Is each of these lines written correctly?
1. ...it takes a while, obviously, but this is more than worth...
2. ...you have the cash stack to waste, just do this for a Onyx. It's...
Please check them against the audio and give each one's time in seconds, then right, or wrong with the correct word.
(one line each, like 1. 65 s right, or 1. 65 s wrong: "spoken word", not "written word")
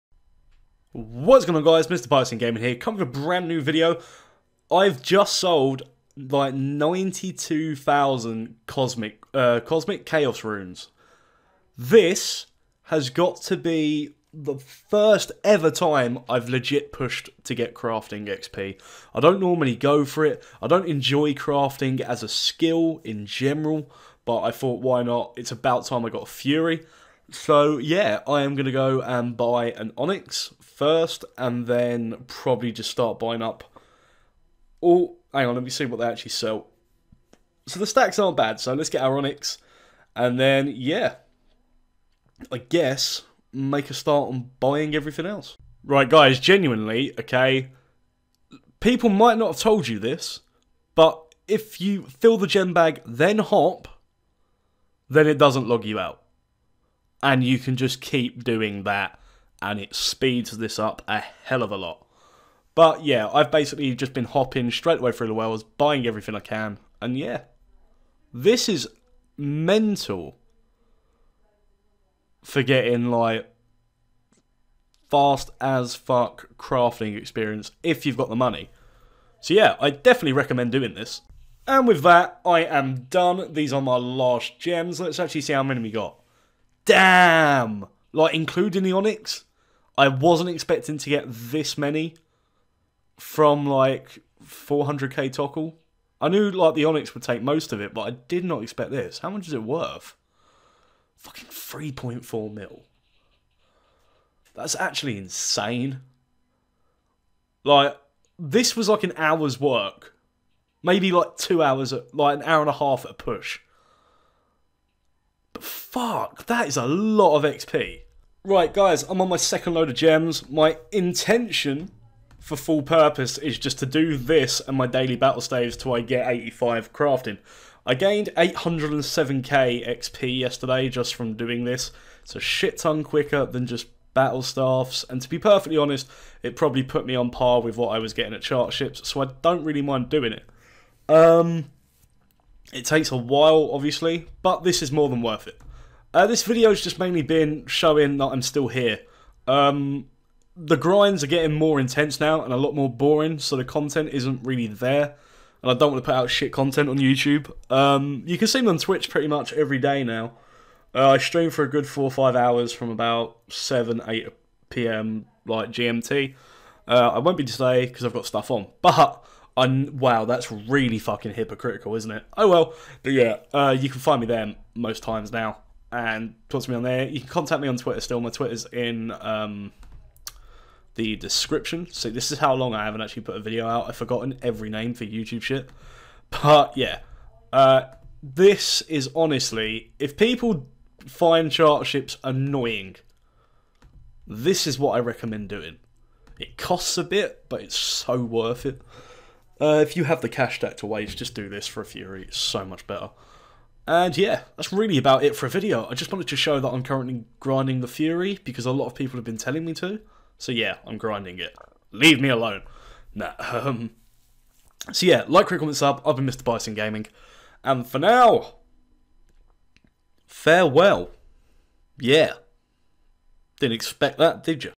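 1. 142 s right
2. 199 s wrong: "Fury", not "Onyx".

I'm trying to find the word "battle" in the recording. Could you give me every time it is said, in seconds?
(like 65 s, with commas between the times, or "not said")
125 s, 134 s.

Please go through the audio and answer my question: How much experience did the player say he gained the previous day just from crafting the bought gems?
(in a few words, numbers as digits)
807k.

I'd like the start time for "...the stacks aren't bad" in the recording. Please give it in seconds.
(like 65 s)
37 s.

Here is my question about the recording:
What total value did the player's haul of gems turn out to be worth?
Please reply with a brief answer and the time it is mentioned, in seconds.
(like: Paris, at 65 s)
3.4 mil, at 101 s.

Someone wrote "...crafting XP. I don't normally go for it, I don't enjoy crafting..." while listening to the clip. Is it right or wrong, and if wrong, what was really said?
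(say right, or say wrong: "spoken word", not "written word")
right.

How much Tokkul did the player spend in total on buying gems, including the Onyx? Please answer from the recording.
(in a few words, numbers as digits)
400k.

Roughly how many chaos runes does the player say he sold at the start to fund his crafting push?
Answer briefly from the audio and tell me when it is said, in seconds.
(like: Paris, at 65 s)
92,000, at 6 s.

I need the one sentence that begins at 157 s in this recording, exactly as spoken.
Um, you can see me on Twitch pretty much every day now.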